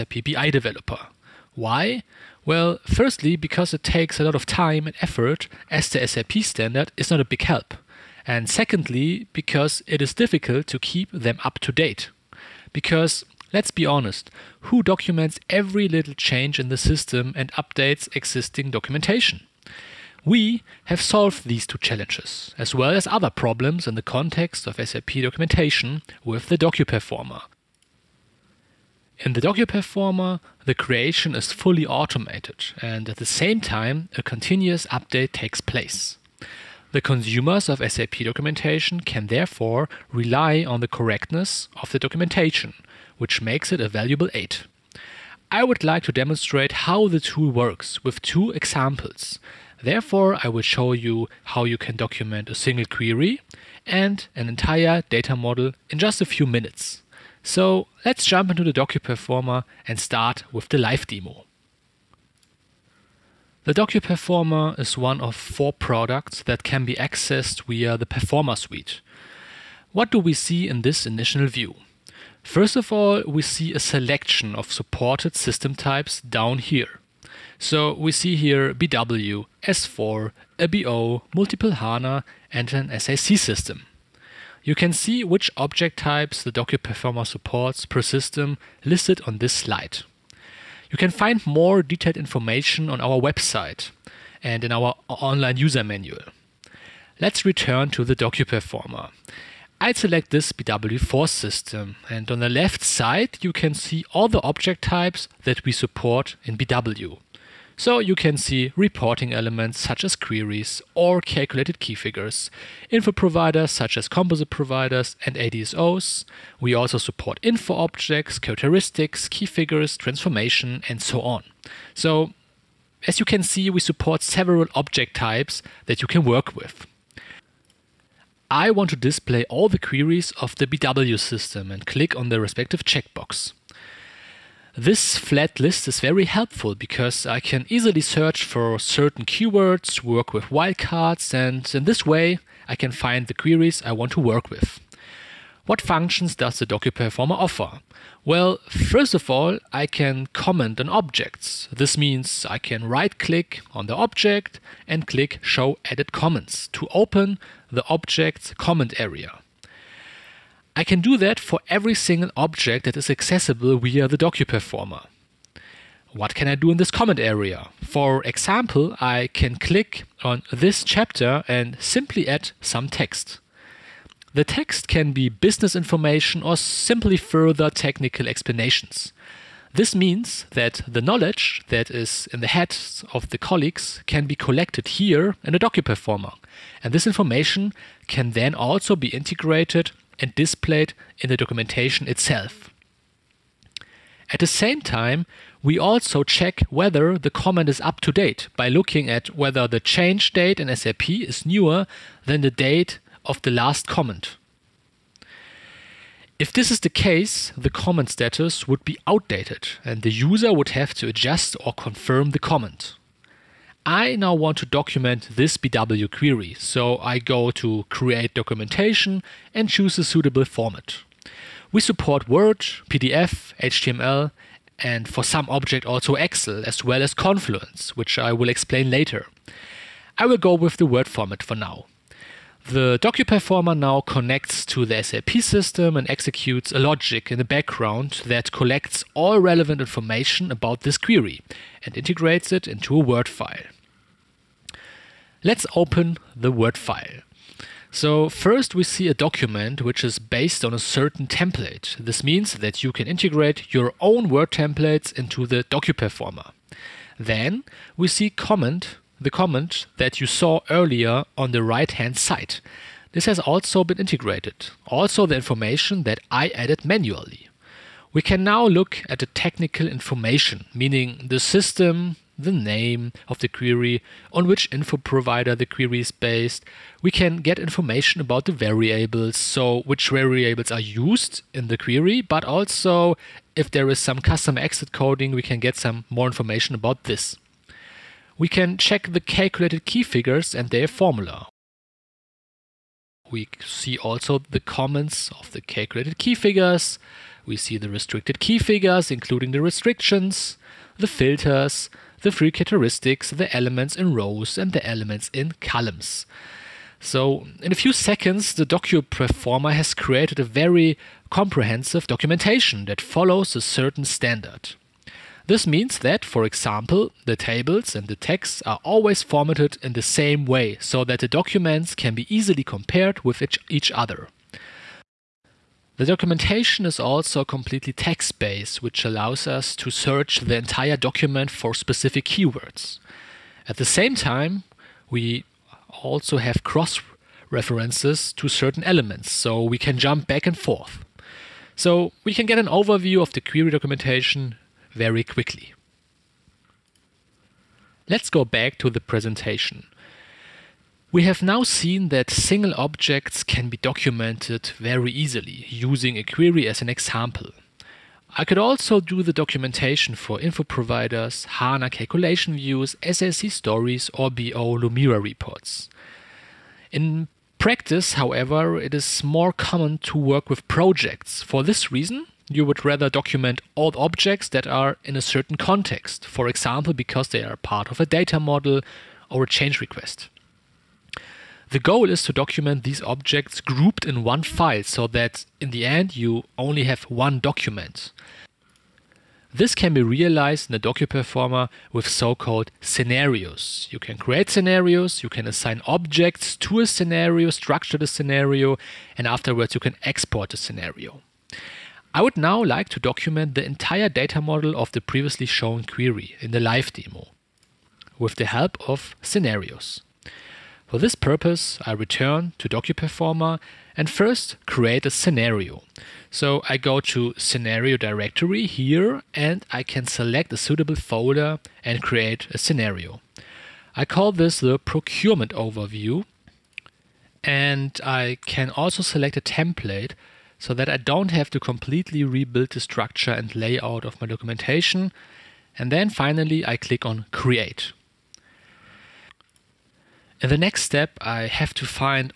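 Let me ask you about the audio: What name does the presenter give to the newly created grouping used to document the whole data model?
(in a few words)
procurement overview.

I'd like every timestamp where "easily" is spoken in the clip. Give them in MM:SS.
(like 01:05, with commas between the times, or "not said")
02:17, 05:22, 05:55.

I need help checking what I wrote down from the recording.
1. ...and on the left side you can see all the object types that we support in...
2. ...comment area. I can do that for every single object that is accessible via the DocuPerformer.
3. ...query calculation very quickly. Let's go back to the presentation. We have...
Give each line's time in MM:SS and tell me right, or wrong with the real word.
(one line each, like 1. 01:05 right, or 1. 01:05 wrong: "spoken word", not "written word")
1. 01:42 right
2. 02:38 right
3. 05:43 wrong: "documentation", not "calculation".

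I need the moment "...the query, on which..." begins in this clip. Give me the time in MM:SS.
04:33.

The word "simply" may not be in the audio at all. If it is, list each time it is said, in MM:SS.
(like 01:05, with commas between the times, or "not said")
02:51, 02:56.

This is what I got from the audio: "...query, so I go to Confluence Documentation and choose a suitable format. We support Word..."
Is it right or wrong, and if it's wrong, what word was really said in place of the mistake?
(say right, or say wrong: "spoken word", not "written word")
wrong: "Create", not "Confluence".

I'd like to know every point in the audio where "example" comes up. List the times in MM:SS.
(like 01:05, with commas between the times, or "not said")
00:48, 02:48, 05:16, 05:56, 06:16.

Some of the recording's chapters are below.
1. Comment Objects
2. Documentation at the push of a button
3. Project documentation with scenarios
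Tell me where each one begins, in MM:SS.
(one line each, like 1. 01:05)
1. 01:00
2. 03:32
3. 05:50.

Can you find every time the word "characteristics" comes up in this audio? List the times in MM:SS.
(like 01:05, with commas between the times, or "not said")
01:58, 05:02.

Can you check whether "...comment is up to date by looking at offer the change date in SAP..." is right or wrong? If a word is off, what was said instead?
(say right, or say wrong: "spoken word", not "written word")
wrong: "whether", not "offer".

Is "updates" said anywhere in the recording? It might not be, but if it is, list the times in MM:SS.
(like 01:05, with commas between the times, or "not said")
00:17, 00:34.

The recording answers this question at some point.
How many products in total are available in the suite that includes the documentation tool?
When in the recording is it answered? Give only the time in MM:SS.
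01:04.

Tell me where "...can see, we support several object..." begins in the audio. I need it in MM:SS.
02:03.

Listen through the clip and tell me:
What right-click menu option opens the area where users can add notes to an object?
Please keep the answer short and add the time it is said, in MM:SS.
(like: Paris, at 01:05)
Show Edit Comments, at 02:35.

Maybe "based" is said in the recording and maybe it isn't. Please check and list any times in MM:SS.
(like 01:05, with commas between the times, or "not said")
04:10, 04:36, 05:27.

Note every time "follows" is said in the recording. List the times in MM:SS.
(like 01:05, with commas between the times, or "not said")
05:13.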